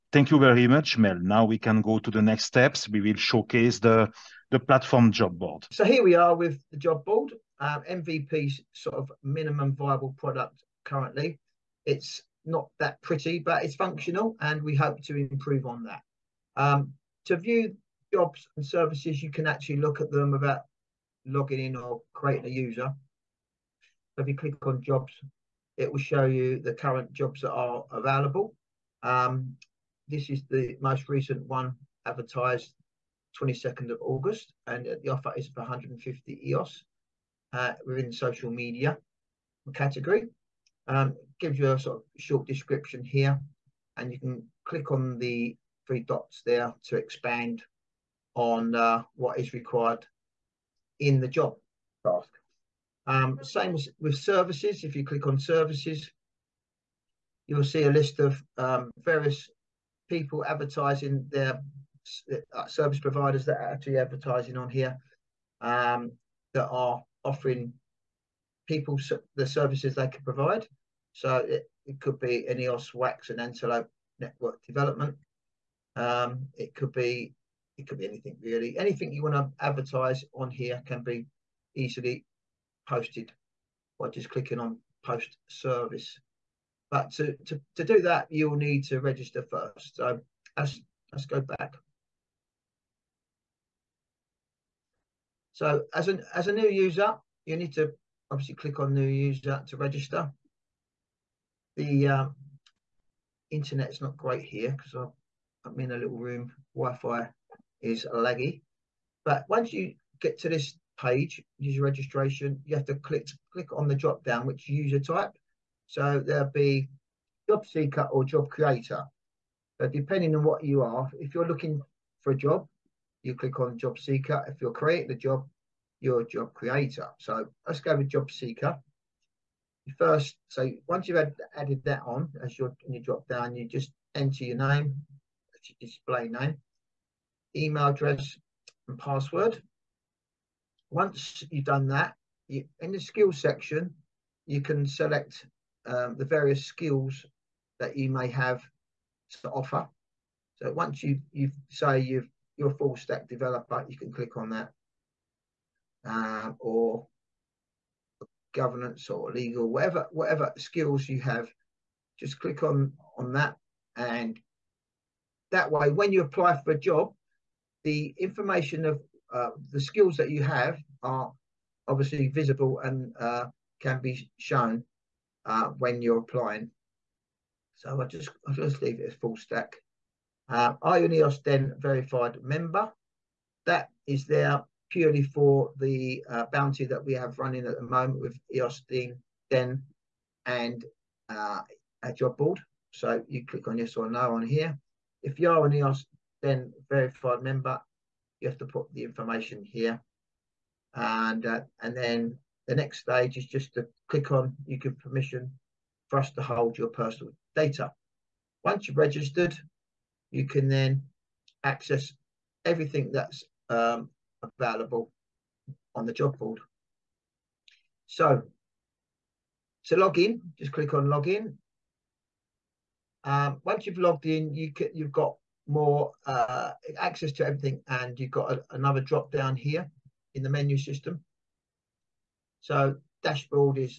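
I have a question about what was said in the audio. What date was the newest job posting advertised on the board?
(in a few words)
22nd of August.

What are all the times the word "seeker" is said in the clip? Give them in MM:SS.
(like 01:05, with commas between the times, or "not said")
01:57, 02:03, 02:08.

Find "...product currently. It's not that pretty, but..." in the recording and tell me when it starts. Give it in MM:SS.
00:10.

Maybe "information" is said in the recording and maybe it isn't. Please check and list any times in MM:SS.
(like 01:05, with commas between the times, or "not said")
02:48, 03:19.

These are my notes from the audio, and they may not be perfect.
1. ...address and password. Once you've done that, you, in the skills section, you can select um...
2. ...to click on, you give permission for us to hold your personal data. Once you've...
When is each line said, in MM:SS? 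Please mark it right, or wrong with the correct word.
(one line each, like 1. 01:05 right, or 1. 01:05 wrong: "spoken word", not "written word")
1. 02:17 right
2. 03:23 right.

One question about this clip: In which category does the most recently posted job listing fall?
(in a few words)
social media.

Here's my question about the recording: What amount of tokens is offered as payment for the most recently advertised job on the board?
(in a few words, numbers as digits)
150 EOS.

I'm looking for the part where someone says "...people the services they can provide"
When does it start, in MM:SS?
01:08.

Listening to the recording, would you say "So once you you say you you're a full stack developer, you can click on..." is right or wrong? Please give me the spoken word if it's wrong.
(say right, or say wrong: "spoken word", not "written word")
right.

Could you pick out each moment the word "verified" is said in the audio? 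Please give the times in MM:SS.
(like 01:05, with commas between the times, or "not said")
03:01, 03:16.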